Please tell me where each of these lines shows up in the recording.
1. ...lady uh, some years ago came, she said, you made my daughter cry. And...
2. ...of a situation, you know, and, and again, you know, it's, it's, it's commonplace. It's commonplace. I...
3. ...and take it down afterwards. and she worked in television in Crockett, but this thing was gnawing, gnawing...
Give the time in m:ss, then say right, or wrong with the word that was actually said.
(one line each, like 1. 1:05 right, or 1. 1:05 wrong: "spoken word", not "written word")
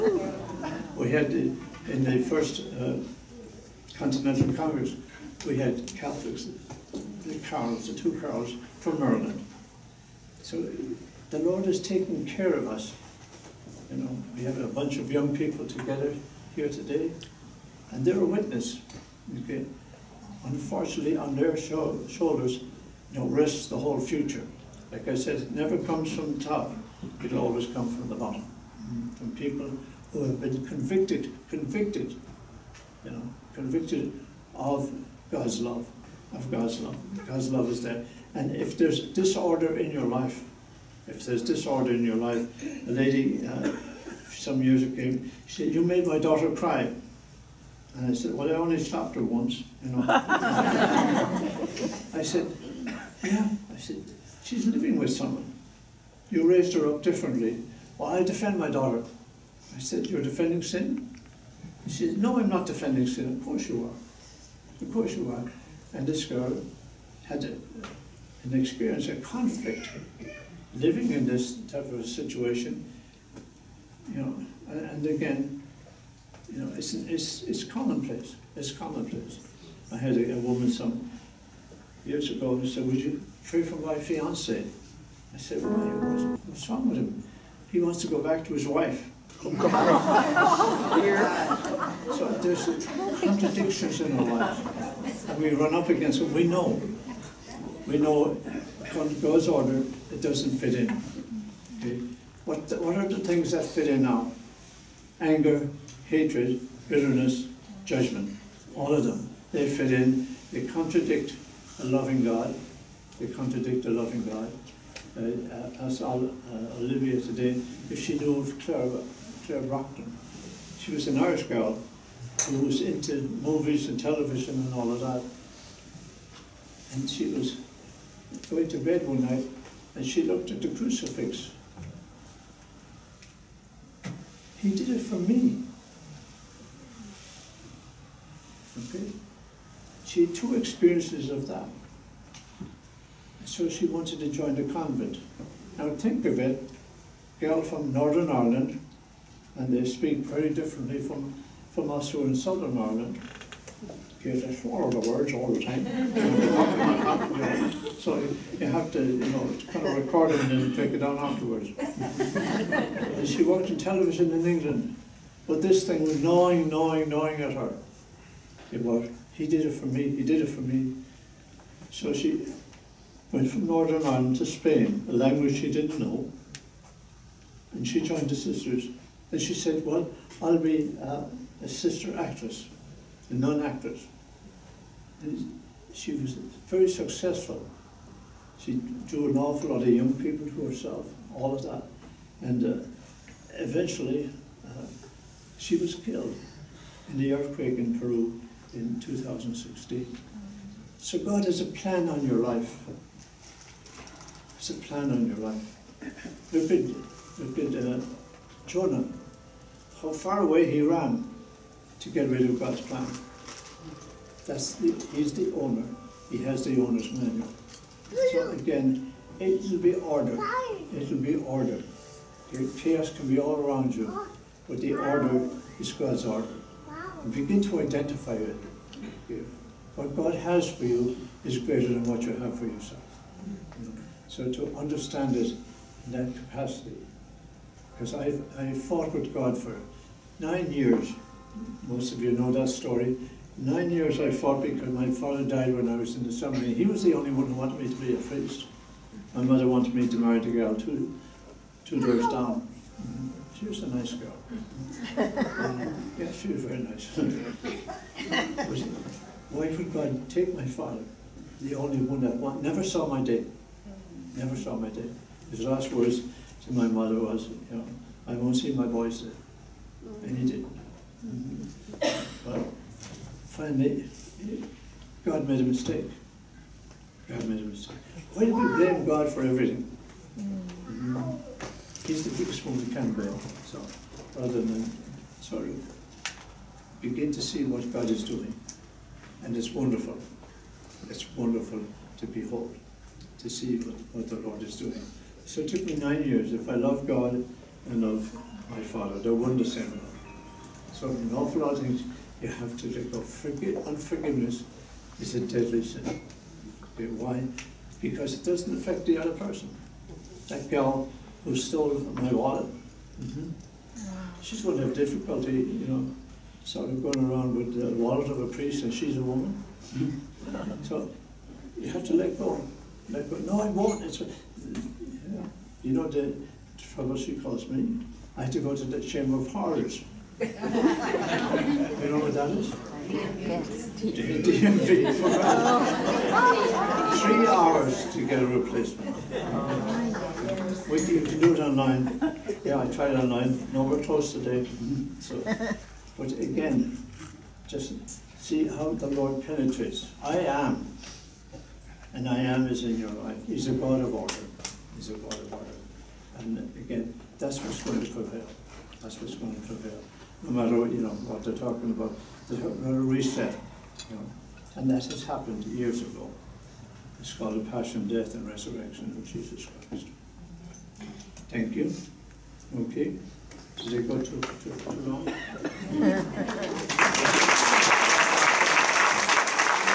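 1. 0:42 right
2. 1:11 right
3. 2:40 wrong: "England", not "Crockett".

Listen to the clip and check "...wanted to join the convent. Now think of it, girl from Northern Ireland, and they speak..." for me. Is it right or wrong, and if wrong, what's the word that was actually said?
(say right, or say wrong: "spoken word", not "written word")
right.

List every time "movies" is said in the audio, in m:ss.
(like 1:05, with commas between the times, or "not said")
2:03.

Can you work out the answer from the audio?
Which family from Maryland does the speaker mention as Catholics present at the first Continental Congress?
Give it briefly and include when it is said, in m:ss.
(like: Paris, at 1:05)
The Carrolls, at 0:07.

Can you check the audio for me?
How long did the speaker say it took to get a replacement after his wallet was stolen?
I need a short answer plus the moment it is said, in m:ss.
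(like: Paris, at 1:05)
3 hours, at 5:37.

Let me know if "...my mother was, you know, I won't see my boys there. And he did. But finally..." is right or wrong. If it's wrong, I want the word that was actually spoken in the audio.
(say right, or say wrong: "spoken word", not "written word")
right.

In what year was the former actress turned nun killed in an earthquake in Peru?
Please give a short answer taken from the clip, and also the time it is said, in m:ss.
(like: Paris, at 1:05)
2016, at 3:18.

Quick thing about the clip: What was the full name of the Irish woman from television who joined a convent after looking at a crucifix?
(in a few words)
Claire Crockett.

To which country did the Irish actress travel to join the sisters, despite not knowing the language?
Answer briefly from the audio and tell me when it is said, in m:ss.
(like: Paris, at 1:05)
Spain, at 2:54.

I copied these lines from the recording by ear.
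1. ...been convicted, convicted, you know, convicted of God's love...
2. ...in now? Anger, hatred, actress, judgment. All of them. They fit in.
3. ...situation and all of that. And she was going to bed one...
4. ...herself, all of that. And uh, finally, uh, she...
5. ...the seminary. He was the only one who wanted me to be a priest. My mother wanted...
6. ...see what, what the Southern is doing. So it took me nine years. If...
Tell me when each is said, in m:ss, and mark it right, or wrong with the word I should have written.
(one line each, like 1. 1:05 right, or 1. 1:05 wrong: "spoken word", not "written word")
1. 0:30 right
2. 1:43 wrong: "bitterness", not "actress"
3. 2:03 wrong: "television", not "situation"
4. 3:10 wrong: "eventually", not "finally"
5. 4:06 right
6. 4:53 wrong: "Lord", not "Southern".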